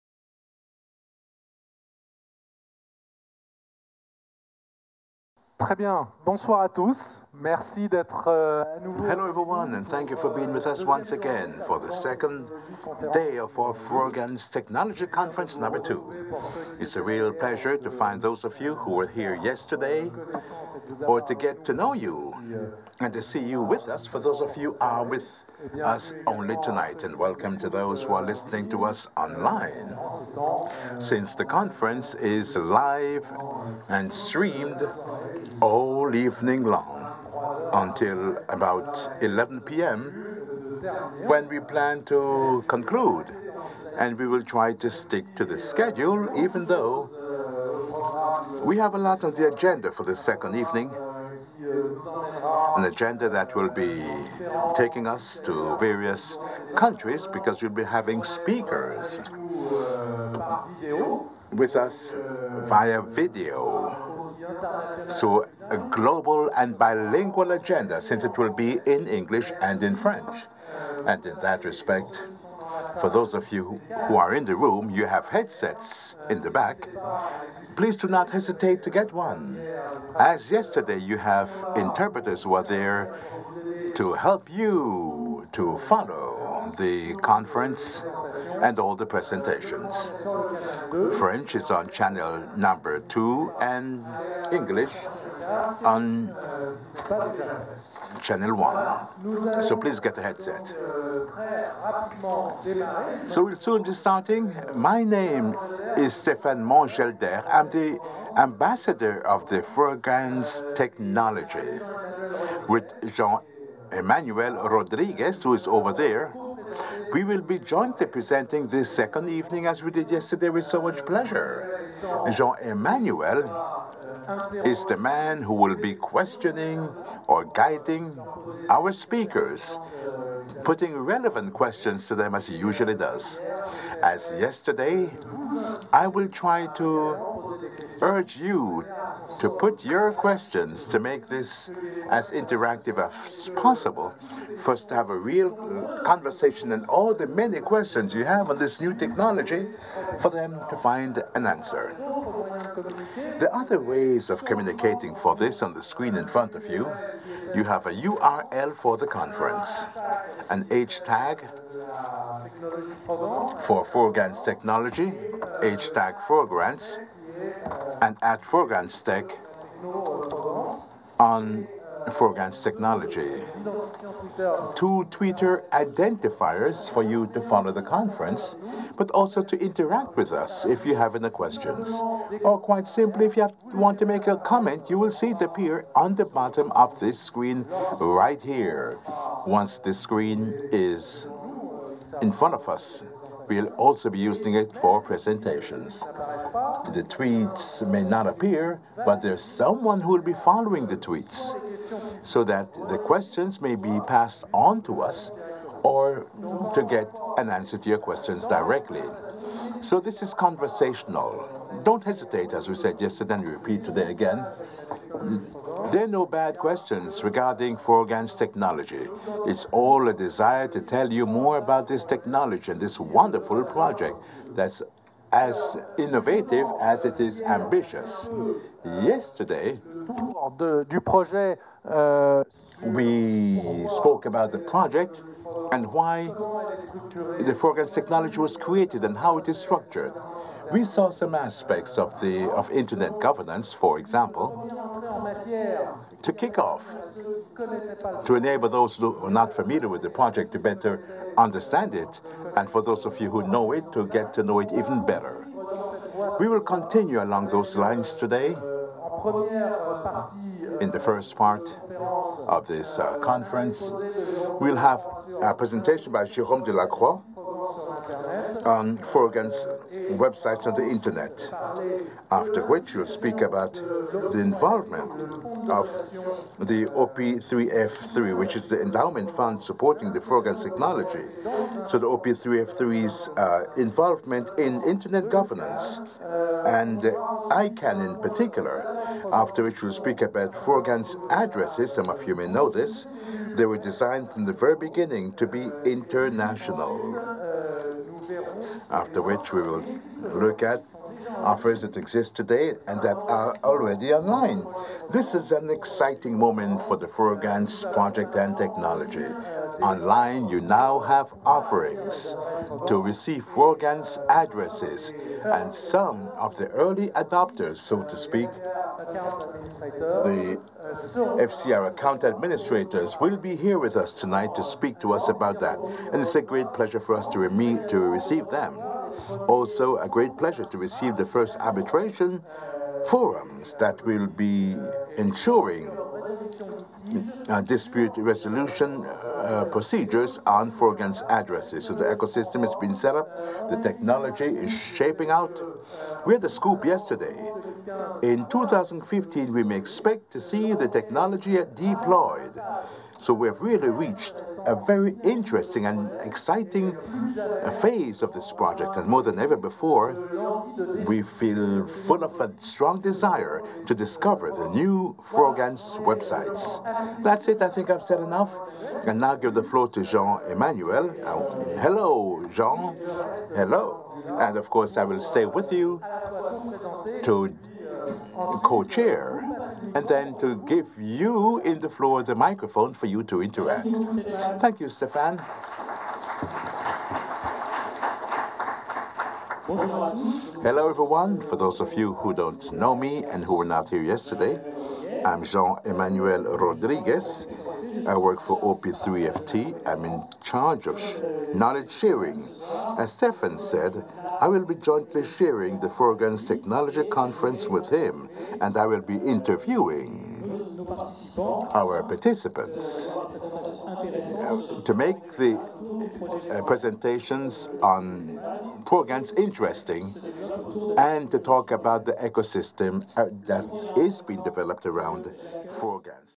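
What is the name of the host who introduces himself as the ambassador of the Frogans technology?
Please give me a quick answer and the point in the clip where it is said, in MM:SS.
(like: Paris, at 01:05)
Stéphane Van Gelder, at 01:46.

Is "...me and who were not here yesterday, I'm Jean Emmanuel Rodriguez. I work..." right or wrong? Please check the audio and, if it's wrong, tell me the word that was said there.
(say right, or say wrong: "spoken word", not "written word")
right.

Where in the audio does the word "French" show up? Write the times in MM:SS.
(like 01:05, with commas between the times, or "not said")
01:09, 01:31.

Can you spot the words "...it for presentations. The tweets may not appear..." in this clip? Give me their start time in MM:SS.
03:14.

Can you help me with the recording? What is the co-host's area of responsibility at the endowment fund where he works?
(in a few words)
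knowledge sharing.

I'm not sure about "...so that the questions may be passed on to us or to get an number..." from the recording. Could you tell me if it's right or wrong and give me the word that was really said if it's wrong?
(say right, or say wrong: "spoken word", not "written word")
wrong: "answer", not "number".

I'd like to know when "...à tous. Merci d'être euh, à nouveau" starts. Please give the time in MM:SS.
00:06.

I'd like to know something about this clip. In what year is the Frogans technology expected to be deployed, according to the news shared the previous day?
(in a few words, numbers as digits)
2015.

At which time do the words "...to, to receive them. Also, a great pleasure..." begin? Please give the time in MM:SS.
05:27.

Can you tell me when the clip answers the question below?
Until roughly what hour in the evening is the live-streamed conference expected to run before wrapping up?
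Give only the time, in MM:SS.
00:39.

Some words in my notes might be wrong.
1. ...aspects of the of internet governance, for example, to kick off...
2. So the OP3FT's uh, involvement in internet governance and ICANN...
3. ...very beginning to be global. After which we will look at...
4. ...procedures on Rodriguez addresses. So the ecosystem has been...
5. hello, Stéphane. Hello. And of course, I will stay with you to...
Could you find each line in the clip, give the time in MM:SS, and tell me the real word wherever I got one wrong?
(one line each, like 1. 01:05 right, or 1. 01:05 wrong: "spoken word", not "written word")
1. 04:01 right
2. 04:41 right
3. 04:54 wrong: "international", not "global"
4. 05:39 wrong: "Frogans", not "Rodriguez"
5. 06:11 wrong: "Jean", not "Stéphane".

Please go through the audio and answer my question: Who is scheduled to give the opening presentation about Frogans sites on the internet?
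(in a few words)
Jérôme Delacroix.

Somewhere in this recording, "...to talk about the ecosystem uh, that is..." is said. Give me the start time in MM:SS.
07:01.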